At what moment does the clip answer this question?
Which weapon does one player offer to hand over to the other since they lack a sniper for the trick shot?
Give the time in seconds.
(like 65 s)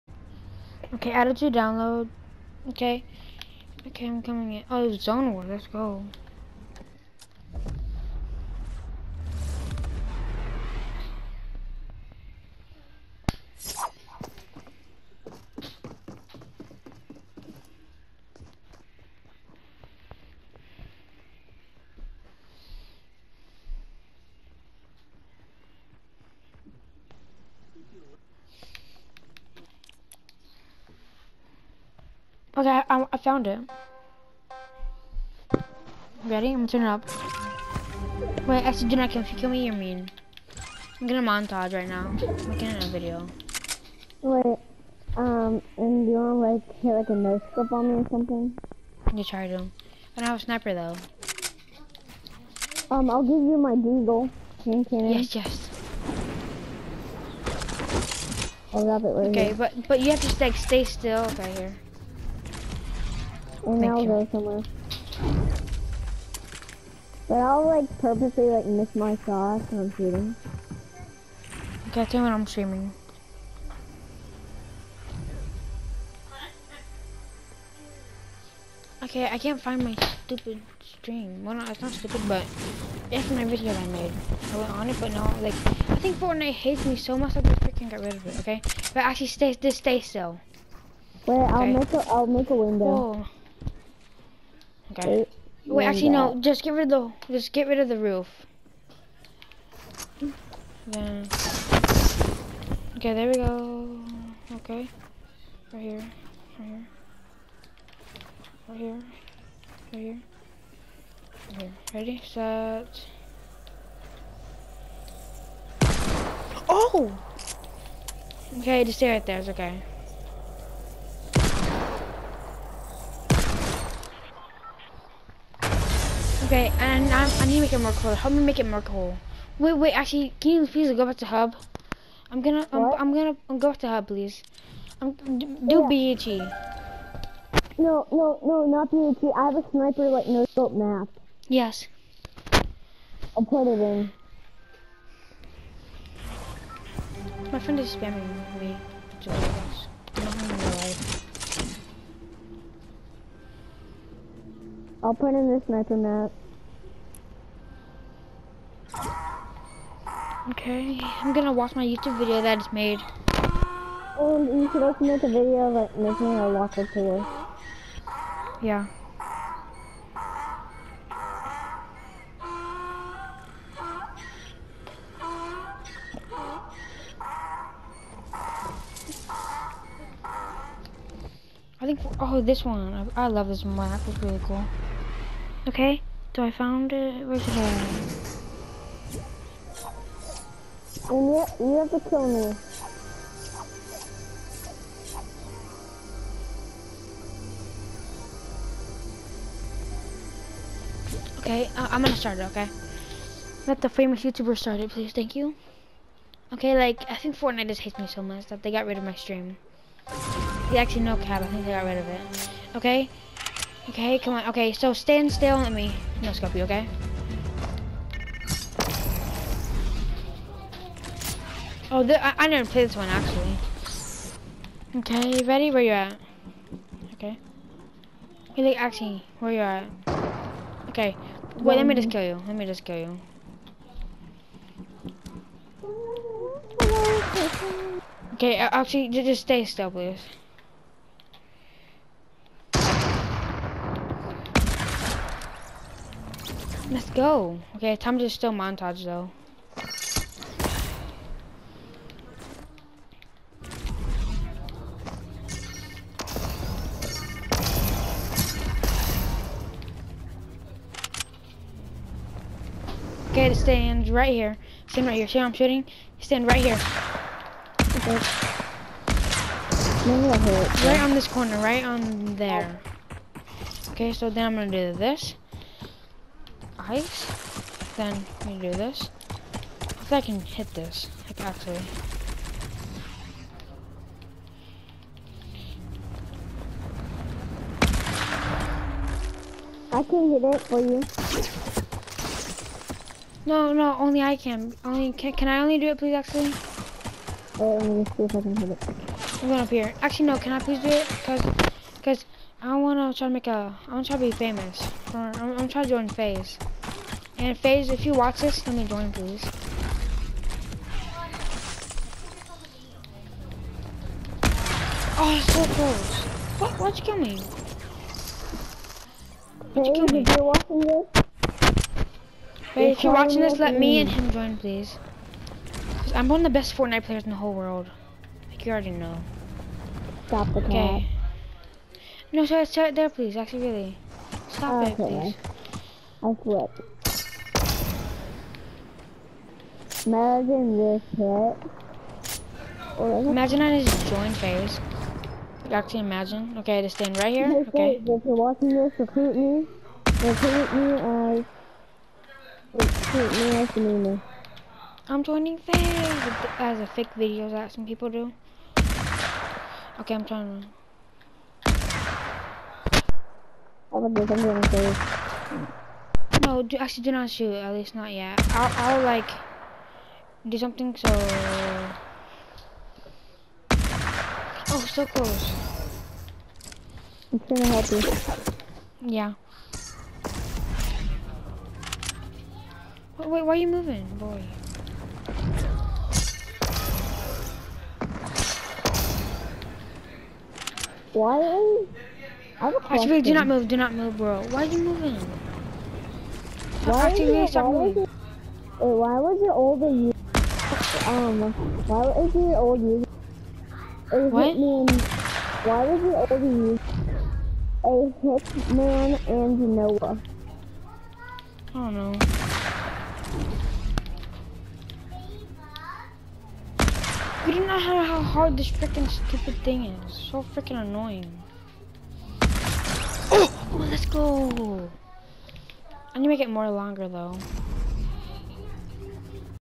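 53 s.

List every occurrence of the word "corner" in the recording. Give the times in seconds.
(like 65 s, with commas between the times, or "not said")
271 s.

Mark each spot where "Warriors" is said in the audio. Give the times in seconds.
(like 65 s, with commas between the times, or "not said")
not said.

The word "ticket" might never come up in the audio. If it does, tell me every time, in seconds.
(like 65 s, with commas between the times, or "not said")
not said.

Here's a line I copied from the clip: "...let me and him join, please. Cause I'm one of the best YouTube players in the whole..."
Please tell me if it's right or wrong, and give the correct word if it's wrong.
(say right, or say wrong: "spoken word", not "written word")
wrong: "Fortnite", not "YouTube".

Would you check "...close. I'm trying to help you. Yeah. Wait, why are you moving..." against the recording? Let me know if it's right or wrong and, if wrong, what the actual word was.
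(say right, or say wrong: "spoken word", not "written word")
right.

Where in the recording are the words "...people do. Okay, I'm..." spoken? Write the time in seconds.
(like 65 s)
357 s.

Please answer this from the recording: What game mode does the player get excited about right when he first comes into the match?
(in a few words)
Zone War.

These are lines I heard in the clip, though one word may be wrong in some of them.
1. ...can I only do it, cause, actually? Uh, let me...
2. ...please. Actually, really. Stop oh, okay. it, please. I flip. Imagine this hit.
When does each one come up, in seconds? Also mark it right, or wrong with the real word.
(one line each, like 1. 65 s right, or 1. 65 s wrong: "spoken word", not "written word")
1. 295 s wrong: "please", not "cause"
2. 333 s right.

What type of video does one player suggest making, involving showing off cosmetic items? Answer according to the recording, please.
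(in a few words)
Locker tour.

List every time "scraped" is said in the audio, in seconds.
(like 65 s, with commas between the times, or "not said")
not said.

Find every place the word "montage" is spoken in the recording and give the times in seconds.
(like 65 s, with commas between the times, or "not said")
41 s, 248 s.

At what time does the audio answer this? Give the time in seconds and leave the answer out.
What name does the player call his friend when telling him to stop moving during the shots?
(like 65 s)
392 s.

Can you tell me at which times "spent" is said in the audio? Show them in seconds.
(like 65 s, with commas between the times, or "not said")
not said.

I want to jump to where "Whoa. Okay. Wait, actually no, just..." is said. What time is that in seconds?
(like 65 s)
92 s.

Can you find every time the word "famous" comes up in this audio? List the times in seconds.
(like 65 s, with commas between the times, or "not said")
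203 s, 304 s.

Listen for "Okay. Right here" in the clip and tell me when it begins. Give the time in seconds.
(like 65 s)
104 s.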